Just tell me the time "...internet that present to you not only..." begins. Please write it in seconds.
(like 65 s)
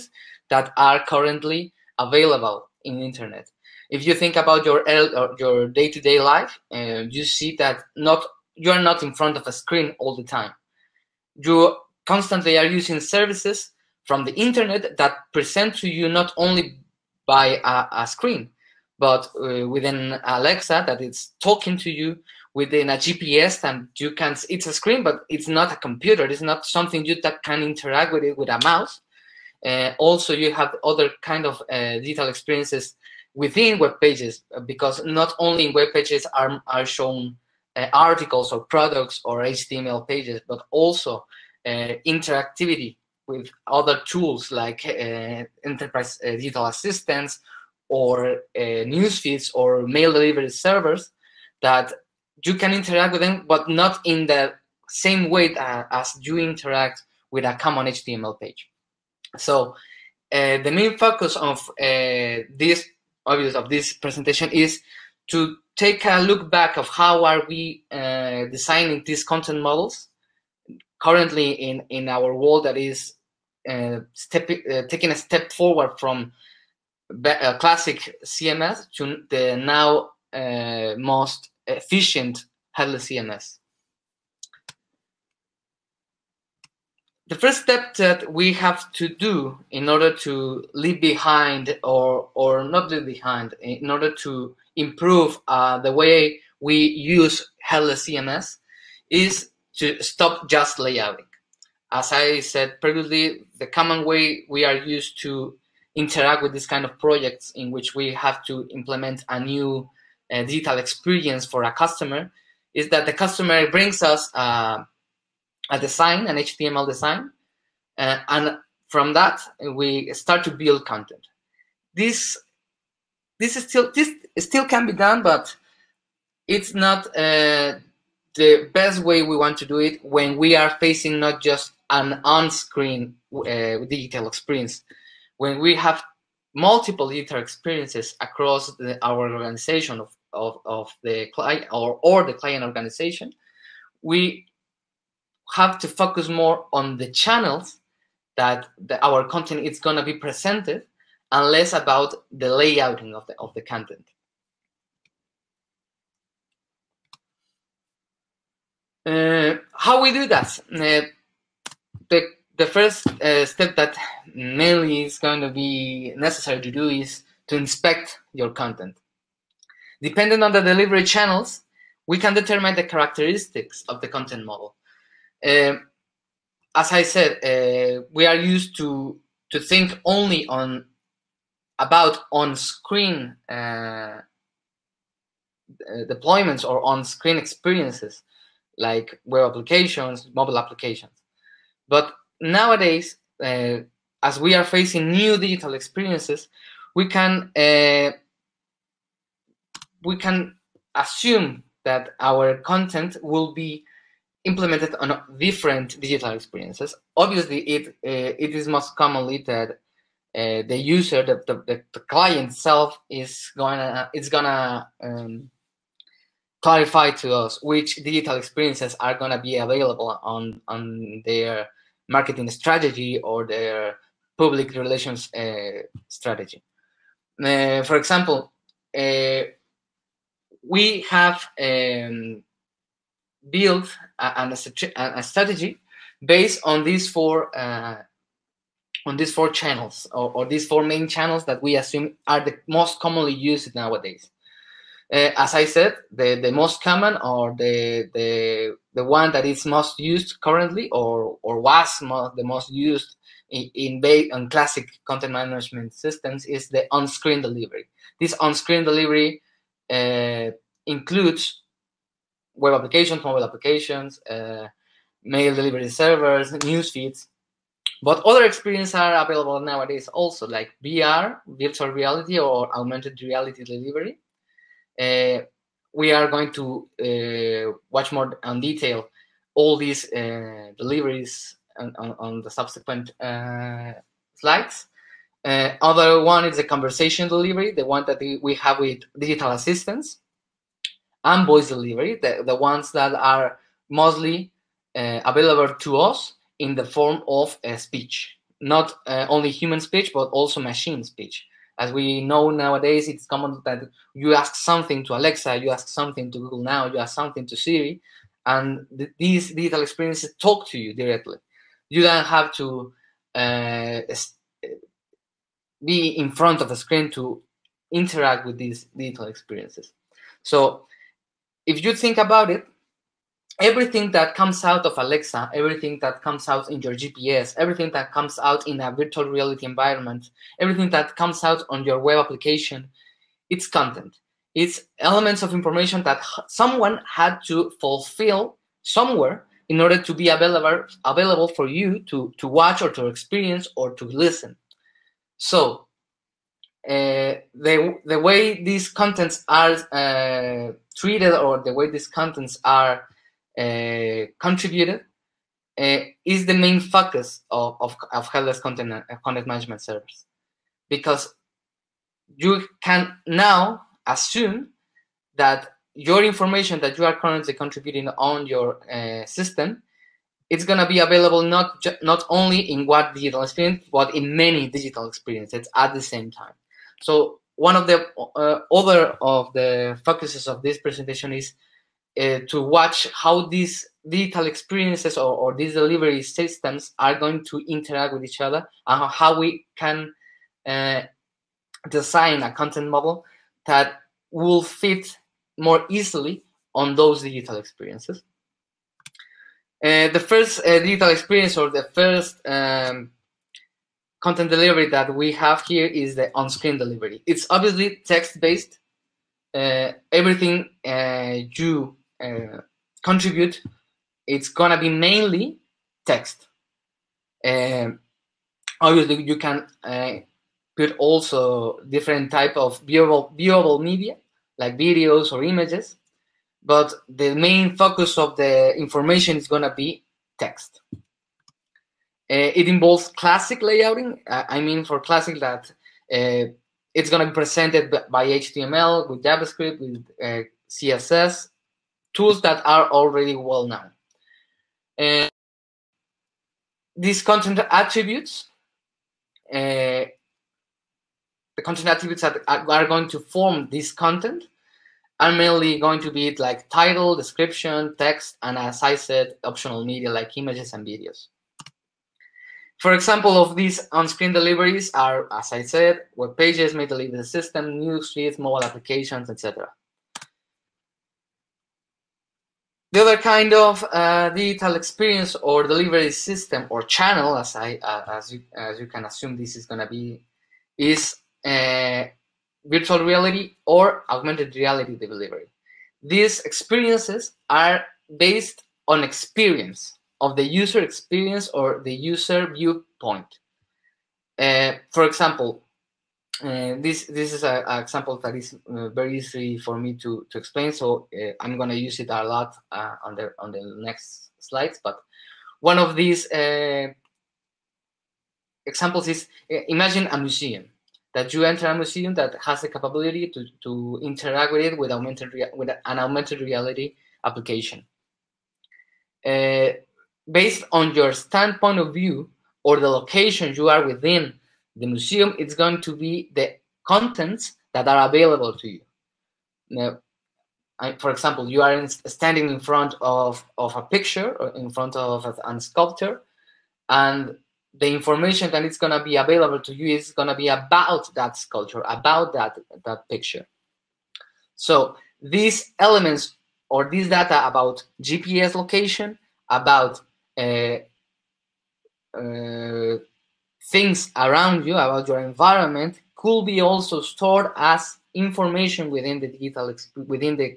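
14 s.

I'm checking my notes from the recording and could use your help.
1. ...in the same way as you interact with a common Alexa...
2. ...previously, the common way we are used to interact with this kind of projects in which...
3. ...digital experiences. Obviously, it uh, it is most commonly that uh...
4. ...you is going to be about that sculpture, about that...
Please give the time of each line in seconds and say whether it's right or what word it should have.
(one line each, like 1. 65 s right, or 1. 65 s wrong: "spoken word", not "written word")
1. 54 s wrong: "HTML", not "Alexa"
2. 102 s right
3. 205 s right
4. 539 s right.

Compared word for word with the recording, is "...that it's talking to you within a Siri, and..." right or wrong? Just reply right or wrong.
wrong.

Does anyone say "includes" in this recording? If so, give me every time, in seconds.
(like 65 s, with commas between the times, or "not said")
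260 s.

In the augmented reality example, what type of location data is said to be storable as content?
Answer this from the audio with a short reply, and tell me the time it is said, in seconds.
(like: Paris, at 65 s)
GPS location, at 548 s.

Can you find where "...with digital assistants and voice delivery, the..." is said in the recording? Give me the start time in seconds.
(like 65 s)
288 s.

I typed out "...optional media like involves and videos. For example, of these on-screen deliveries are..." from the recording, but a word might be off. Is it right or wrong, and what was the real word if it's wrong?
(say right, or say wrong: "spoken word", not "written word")
wrong: "images", not "involves".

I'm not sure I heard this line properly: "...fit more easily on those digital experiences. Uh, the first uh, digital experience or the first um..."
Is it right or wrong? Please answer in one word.
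right.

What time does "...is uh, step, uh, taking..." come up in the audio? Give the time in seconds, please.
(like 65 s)
72 s.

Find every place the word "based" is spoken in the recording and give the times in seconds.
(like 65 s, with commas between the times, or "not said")
236 s, 408 s, 488 s, 520 s.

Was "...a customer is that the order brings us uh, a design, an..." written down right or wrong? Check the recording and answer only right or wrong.
wrong.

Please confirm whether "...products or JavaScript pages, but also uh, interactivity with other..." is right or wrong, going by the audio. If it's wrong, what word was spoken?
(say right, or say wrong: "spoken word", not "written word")
wrong: "HTML", not "JavaScript".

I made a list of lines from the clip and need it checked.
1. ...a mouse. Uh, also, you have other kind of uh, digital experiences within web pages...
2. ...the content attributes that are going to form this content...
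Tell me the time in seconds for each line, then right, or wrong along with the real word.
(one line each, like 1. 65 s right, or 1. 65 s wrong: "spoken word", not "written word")
1. 28 s right
2. 451 s right.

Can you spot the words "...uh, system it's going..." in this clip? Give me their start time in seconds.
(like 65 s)
368 s.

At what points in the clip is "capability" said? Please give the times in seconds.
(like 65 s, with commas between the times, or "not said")
512 s.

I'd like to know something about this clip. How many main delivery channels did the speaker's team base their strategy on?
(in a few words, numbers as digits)
4.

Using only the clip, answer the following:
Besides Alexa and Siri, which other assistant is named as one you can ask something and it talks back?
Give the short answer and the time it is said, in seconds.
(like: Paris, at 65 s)
Google Now, at 306 s.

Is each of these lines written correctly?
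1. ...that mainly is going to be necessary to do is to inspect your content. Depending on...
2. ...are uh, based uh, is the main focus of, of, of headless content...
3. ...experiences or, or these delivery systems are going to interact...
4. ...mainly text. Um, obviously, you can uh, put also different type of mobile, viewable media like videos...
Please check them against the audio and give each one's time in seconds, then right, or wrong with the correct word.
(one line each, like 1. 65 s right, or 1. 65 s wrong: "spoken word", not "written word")
1. 163 s right
2. 352 s wrong: "contributed", not "based"
3. 384 s right
4. 414 s wrong: "viewable", not "mobile".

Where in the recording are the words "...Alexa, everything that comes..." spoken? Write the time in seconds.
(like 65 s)
324 s.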